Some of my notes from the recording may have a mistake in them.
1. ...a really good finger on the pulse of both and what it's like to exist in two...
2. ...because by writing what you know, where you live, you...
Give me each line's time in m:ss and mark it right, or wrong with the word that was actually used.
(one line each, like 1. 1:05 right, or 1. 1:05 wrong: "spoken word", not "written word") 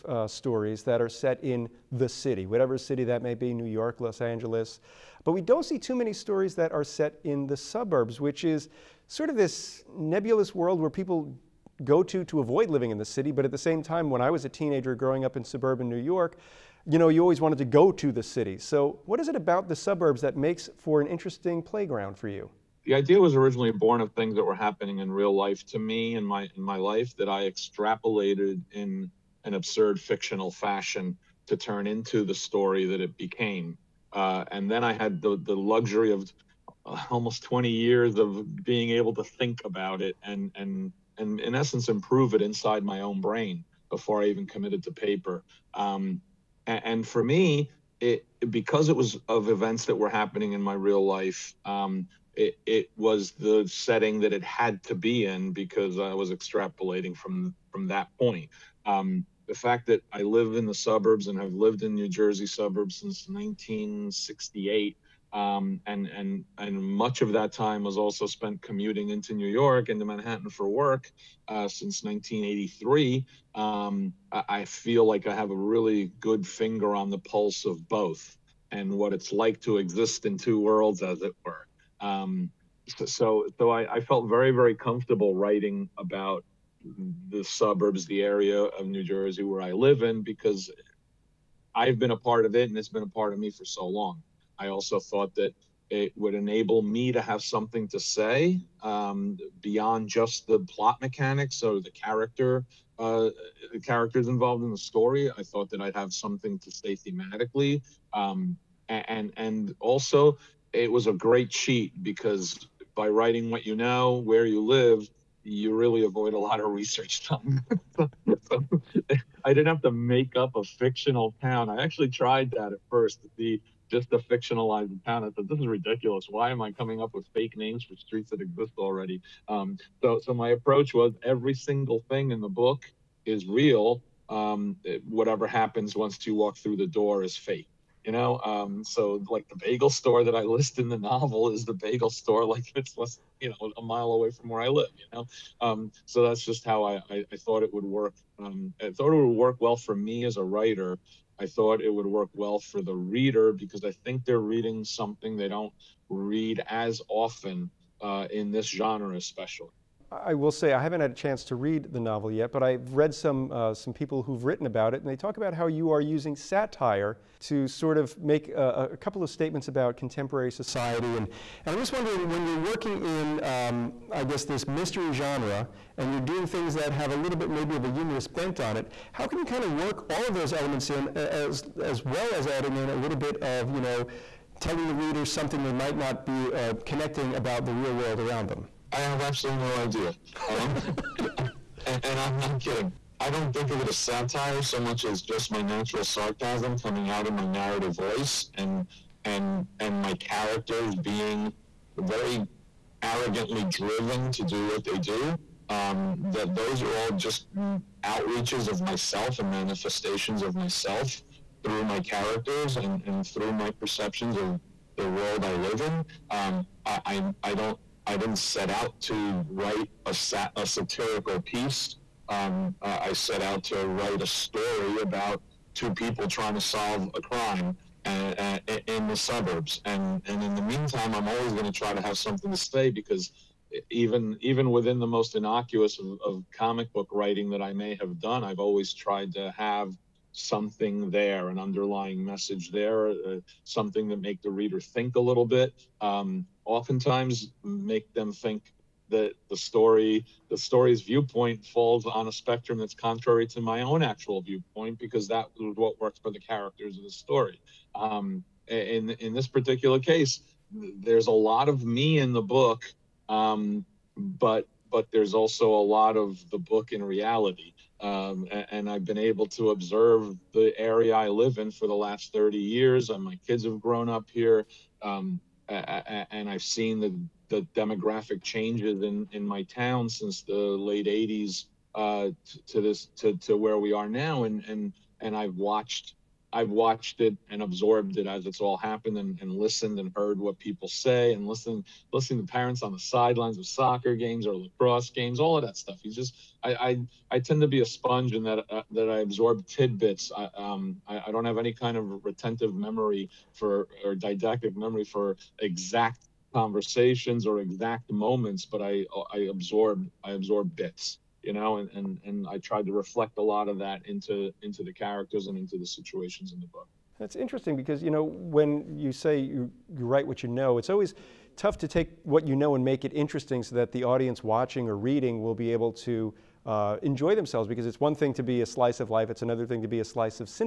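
1. 1:15 right
2. 1:52 right.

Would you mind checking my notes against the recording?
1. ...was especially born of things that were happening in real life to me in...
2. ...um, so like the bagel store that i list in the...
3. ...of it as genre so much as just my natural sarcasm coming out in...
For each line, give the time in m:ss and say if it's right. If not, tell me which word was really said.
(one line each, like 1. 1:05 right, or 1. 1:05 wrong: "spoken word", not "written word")
1. 0:23 wrong: "originally", not "especially"
2. 2:18 right
3. 3:13 wrong: "satire", not "genre".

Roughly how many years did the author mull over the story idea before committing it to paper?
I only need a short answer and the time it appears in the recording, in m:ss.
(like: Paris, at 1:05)
20 years, at 0:37.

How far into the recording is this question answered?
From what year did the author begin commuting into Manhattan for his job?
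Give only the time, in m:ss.
1:12.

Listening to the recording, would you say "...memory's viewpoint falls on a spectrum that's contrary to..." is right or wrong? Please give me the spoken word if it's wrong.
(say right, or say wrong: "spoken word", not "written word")
wrong: "story", not "memory".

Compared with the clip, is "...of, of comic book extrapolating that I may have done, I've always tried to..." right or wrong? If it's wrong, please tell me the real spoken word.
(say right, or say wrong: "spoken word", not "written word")
wrong: "writing", not "extrapolating".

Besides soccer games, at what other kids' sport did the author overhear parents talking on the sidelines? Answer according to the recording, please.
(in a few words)
Lacrosse.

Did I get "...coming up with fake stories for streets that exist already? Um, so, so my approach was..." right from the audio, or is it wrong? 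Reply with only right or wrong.
wrong.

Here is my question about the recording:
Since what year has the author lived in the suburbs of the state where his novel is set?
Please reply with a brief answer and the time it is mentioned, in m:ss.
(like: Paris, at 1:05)
1968, at 1:03.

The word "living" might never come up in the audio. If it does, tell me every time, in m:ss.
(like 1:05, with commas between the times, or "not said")
0:12.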